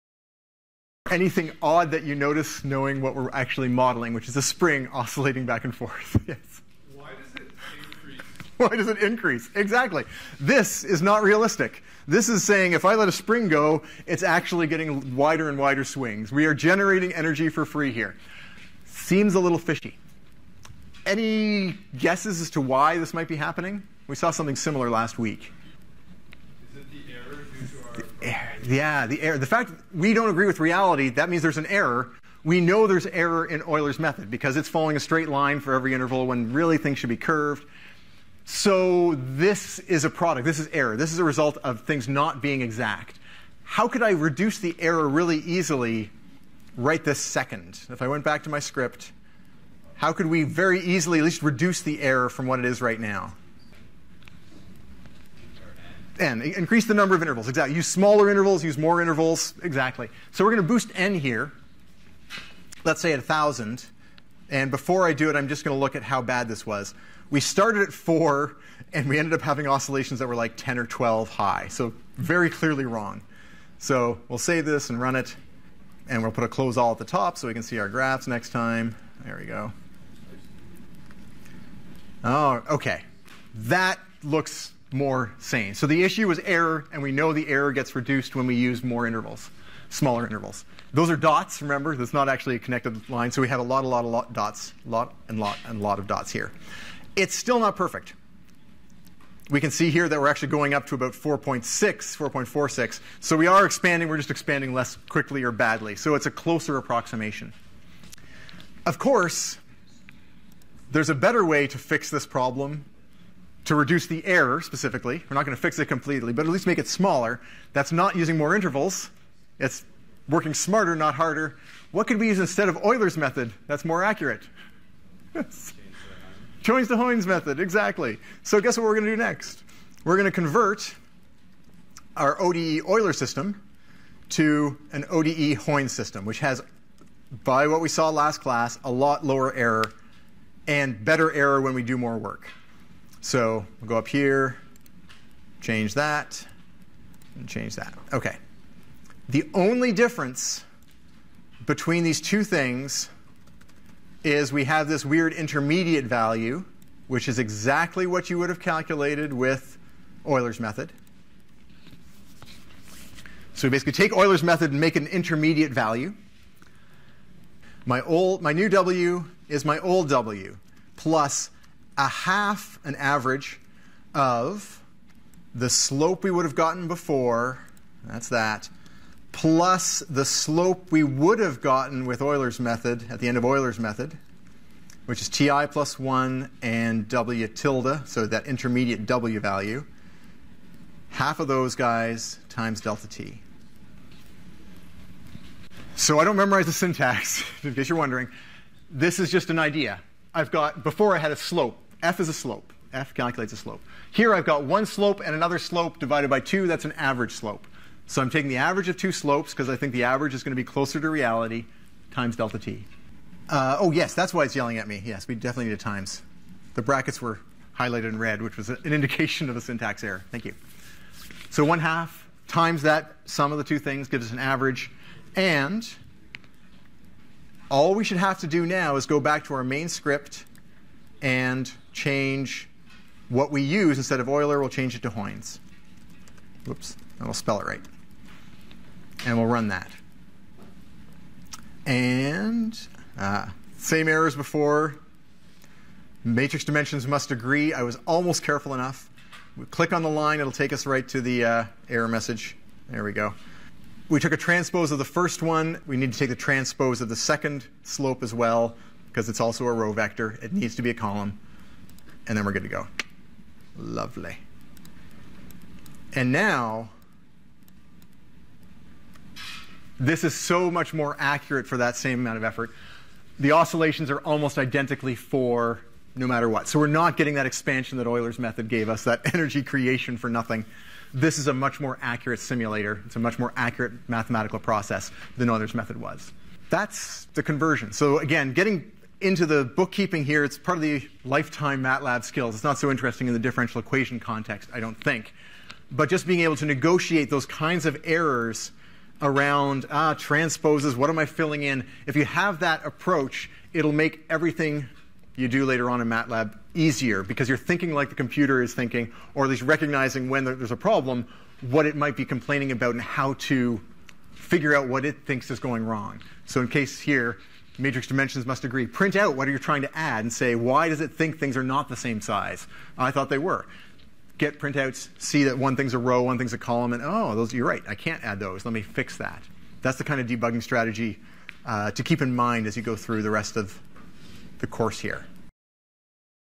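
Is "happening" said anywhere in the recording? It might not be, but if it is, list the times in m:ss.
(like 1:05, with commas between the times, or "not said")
0:23.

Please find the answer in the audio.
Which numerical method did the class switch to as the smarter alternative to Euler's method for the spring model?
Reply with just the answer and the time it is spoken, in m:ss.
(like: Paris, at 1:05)
Heun's method, at 2:06.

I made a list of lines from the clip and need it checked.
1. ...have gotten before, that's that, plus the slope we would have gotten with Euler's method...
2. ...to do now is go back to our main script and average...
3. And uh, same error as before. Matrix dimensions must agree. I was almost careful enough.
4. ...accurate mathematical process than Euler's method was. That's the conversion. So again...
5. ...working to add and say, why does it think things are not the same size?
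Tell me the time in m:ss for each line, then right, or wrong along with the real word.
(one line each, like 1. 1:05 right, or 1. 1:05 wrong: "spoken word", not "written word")
1. 2:56 right
2. 3:48 wrong: "change", not "average"
3. 4:01 right
4. 4:43 right
5. 5:19 wrong: "trying", not "working".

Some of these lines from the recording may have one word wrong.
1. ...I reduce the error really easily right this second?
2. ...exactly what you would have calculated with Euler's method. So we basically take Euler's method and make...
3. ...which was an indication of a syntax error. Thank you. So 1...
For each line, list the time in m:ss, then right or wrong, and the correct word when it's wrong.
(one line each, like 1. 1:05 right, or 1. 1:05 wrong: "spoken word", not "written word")
1. 0:44 right
2. 2:37 right
3. 3:38 right.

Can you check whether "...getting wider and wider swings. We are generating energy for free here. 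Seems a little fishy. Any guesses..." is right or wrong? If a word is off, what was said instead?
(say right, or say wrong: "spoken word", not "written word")
right.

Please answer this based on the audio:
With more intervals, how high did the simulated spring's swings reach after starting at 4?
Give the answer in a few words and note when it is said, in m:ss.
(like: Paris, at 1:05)
4.46, at 1:41.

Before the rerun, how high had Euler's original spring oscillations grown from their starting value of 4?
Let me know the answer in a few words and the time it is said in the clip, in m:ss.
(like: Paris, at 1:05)
10 or 12, at 1:10.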